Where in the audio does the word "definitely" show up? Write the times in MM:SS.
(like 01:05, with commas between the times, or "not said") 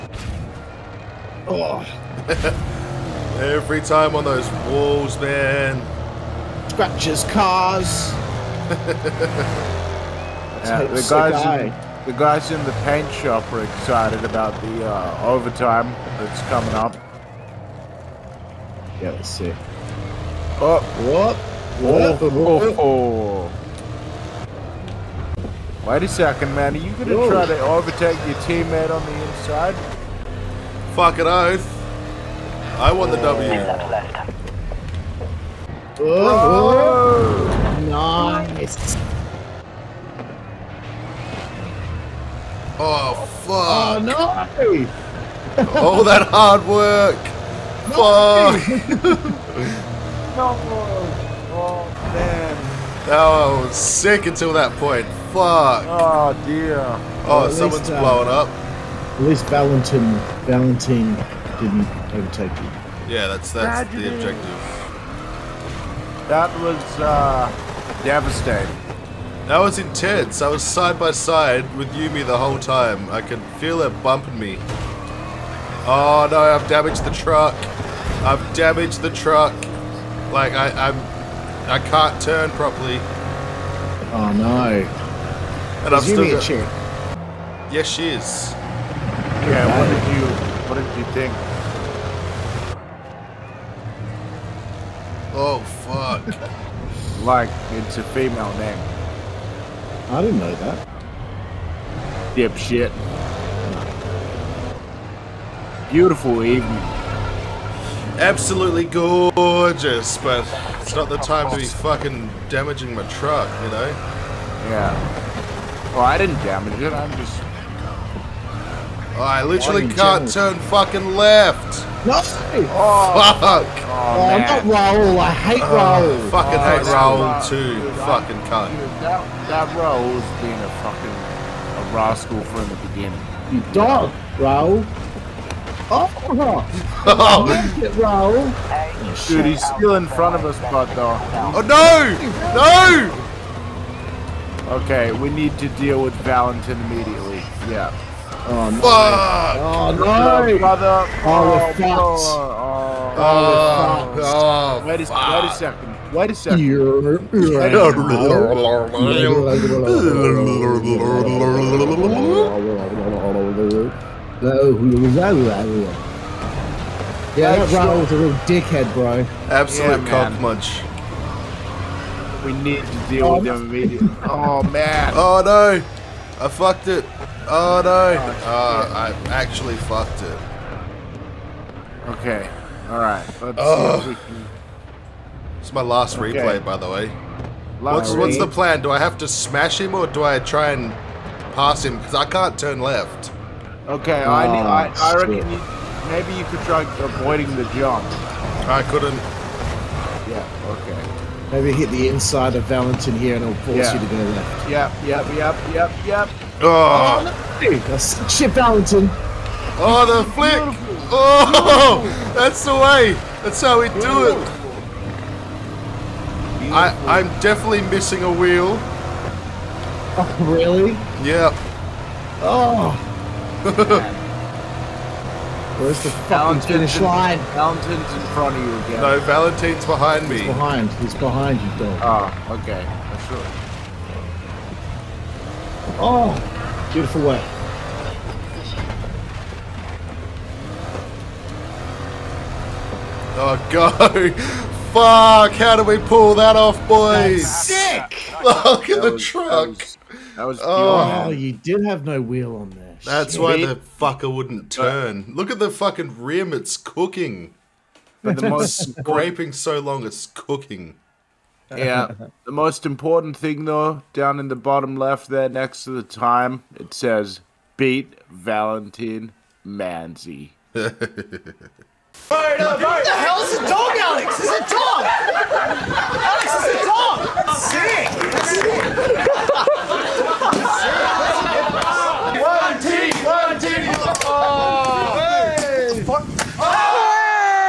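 03:37.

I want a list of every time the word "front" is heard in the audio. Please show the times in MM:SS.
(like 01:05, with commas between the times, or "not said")
02:20, 03:48.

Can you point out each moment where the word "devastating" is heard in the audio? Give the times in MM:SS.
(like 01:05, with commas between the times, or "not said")
01:08.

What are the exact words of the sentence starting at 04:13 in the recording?
That's, why the fucker wouldn't turn.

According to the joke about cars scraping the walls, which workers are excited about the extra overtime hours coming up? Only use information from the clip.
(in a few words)
The guys in the paint shop.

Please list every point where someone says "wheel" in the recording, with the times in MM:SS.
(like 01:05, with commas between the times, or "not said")
03:38, 04:12.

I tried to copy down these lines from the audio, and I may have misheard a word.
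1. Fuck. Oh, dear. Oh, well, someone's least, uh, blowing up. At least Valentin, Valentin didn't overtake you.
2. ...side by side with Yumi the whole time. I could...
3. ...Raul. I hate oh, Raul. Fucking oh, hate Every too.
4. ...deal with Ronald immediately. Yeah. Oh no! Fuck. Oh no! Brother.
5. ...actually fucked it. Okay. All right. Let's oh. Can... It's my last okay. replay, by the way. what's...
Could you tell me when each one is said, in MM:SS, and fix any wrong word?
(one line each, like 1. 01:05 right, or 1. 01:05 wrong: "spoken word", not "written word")
1. 00:55 right
2. 01:10 right
3. 02:04 wrong: "Raul", not "Every"
4. 02:25 wrong: "Valentin", not "Ronald"
5. 02:59 right.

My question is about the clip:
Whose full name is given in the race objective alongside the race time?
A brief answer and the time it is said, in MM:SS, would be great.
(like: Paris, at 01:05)
Valentin Manzi, at 04:28.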